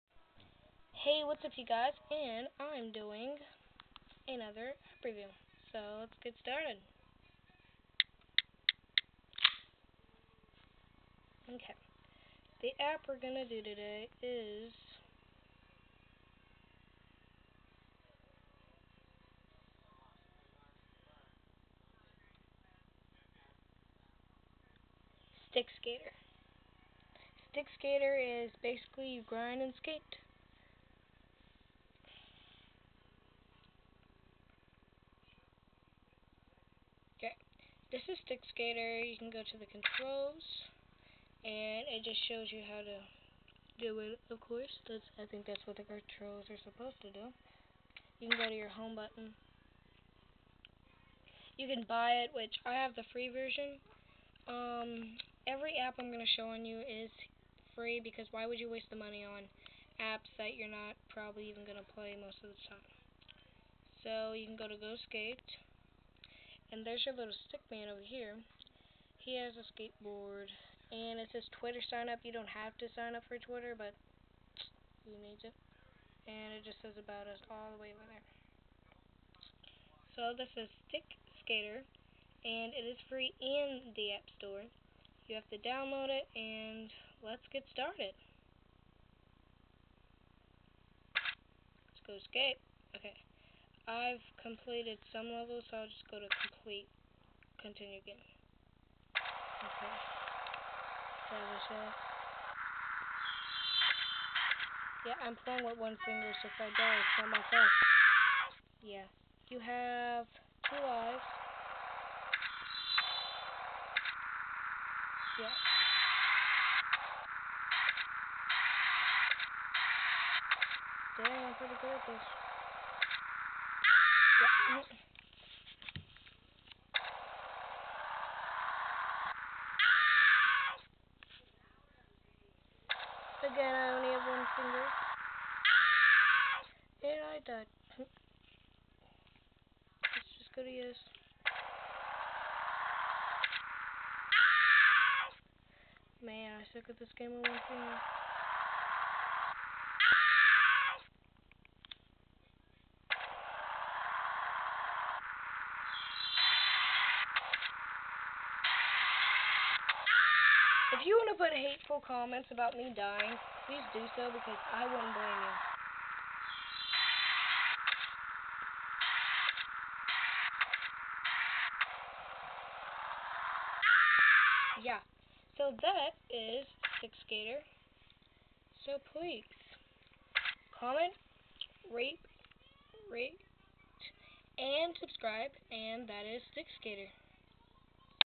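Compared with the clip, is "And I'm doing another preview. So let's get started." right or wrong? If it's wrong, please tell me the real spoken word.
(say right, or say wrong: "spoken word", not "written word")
right.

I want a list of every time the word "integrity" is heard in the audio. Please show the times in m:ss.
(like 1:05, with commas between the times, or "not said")
not said.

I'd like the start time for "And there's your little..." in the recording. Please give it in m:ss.
1:06.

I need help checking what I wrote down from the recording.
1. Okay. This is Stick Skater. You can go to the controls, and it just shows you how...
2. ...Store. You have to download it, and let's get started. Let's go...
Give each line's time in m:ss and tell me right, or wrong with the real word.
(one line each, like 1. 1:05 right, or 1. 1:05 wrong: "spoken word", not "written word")
1. 0:37 right
2. 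1:24 right.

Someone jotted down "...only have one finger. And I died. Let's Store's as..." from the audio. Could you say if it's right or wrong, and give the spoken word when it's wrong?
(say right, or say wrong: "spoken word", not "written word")
wrong: "That", not "Store".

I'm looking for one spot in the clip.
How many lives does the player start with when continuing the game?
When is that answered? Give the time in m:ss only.
1:50.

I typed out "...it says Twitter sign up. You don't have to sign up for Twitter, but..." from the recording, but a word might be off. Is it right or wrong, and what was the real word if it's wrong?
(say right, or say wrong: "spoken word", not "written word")
right.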